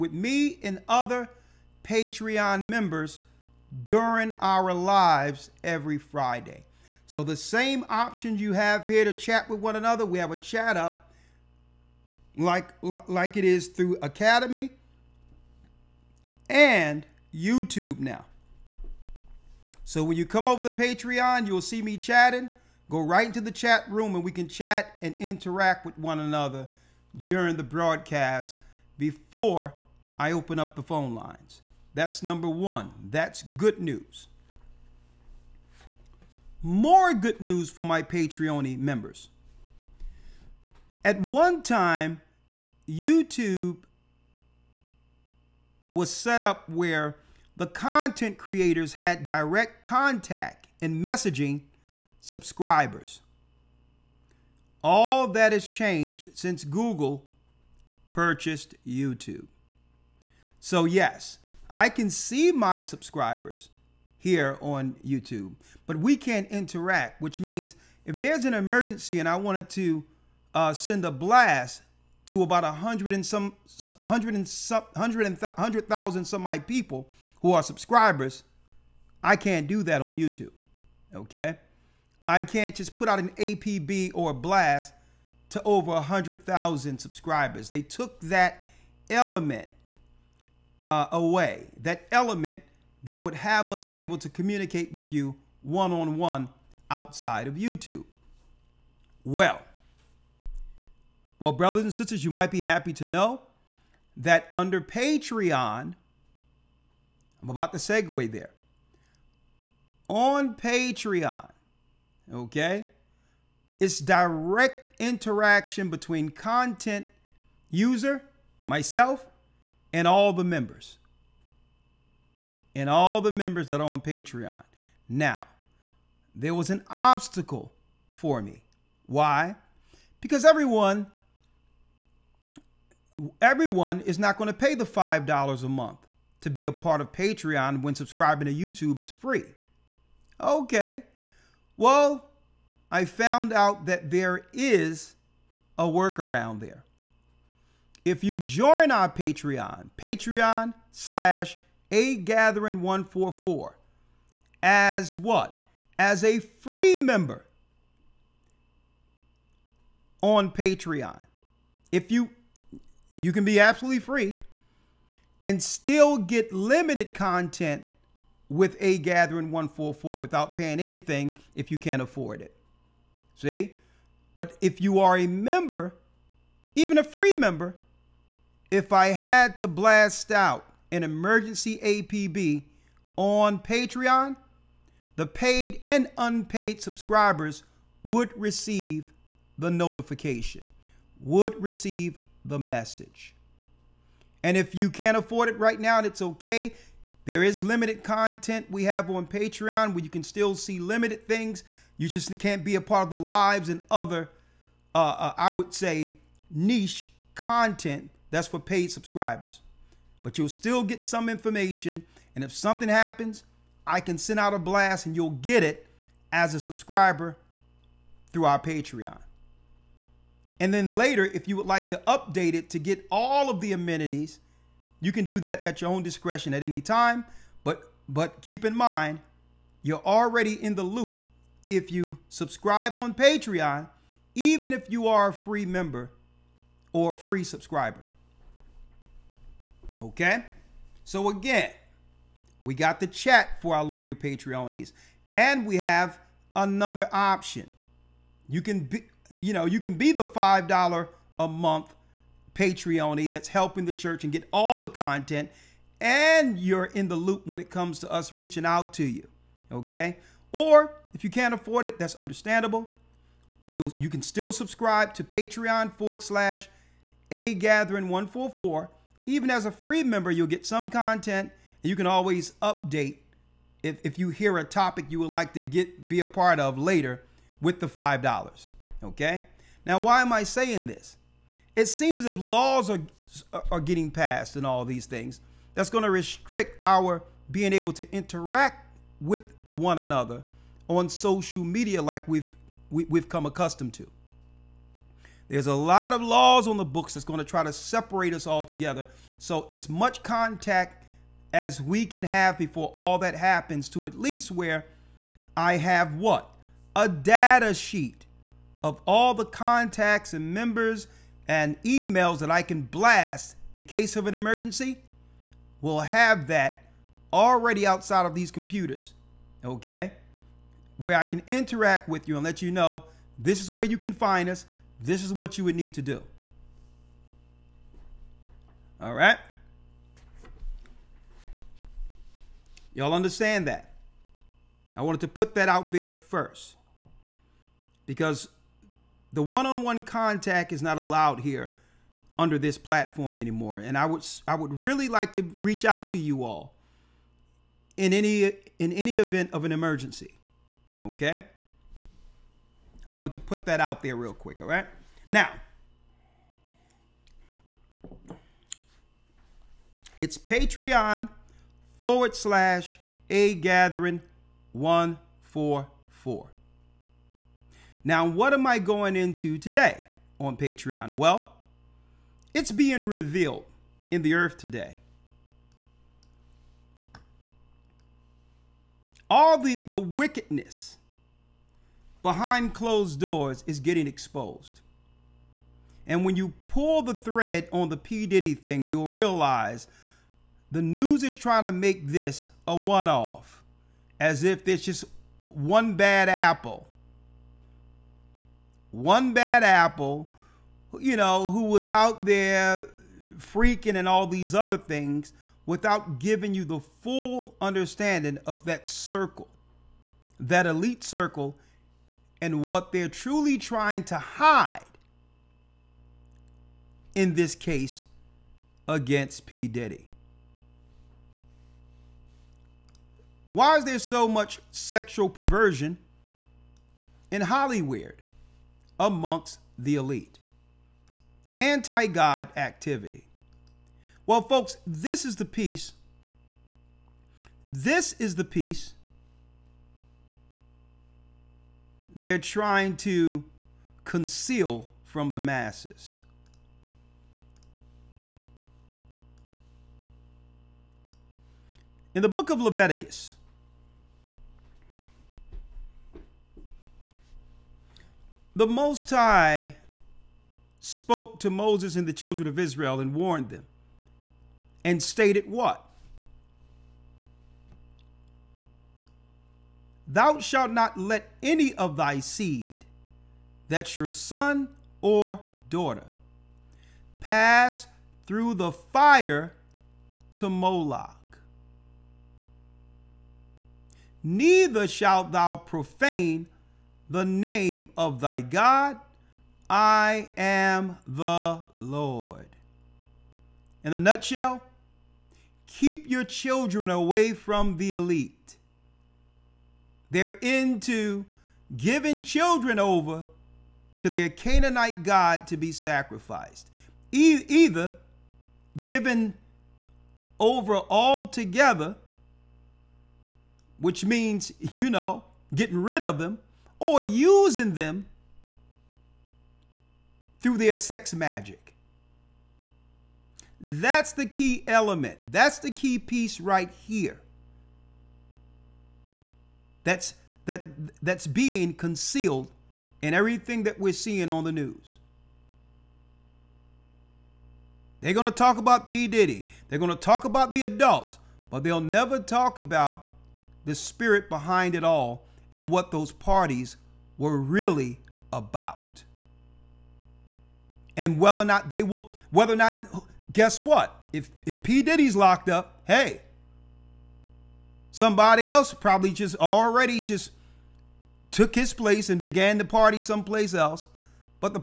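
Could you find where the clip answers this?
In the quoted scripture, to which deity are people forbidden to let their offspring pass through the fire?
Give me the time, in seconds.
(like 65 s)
480 s.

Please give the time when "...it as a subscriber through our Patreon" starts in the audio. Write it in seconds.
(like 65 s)
215 s.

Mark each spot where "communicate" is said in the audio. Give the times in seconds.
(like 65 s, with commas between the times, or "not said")
94 s.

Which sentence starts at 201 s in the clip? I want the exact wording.
You just can't be a part of the lives and other, uh, uh, I would say, niche content that's for paid subscribers.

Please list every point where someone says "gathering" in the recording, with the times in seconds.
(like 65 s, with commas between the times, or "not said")
152 s, 168 s, 267 s, 363 s.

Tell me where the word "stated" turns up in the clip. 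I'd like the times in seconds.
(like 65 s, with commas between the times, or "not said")
465 s.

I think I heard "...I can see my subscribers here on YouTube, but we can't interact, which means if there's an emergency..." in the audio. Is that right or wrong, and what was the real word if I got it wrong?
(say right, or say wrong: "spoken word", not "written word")
right.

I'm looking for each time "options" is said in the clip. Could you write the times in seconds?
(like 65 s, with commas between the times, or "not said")
7 s, 247 s.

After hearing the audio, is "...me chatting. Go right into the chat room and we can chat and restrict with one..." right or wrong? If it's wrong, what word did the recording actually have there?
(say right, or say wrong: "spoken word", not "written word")
wrong: "interact", not "restrict".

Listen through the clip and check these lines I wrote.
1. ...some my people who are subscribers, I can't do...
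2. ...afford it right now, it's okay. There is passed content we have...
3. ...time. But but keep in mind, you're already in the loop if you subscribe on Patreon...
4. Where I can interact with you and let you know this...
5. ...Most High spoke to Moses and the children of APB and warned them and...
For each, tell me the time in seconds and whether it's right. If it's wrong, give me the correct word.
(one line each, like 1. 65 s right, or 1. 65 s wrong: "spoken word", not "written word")
1. 76 s right
2. 195 s wrong: "limited", not "passed"
3. 226 s right
4. 320 s right
5. 458 s wrong: "Israel", not "APB".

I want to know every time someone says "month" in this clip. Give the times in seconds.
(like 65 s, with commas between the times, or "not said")
135 s, 251 s.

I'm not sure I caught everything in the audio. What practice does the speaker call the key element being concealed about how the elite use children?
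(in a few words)
sex magic.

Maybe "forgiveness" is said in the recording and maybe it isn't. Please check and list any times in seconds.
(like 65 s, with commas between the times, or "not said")
not said.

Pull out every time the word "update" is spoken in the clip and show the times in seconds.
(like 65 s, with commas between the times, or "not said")
222 s, 272 s.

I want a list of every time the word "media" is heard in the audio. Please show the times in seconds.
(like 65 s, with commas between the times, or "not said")
291 s.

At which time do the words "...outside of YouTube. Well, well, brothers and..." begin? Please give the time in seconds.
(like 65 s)
96 s.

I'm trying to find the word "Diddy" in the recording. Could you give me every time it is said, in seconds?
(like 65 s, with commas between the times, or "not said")
388 s, 419 s, 539 s, 554 s.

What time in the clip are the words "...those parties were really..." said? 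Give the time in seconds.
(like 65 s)
545 s.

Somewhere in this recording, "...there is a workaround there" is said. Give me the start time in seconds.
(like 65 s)
144 s.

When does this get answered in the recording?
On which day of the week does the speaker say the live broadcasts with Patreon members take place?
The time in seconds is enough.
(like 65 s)
5 s.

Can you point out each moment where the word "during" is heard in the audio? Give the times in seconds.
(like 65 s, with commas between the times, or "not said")
3 s, 27 s.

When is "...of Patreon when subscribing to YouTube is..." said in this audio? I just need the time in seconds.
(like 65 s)
136 s.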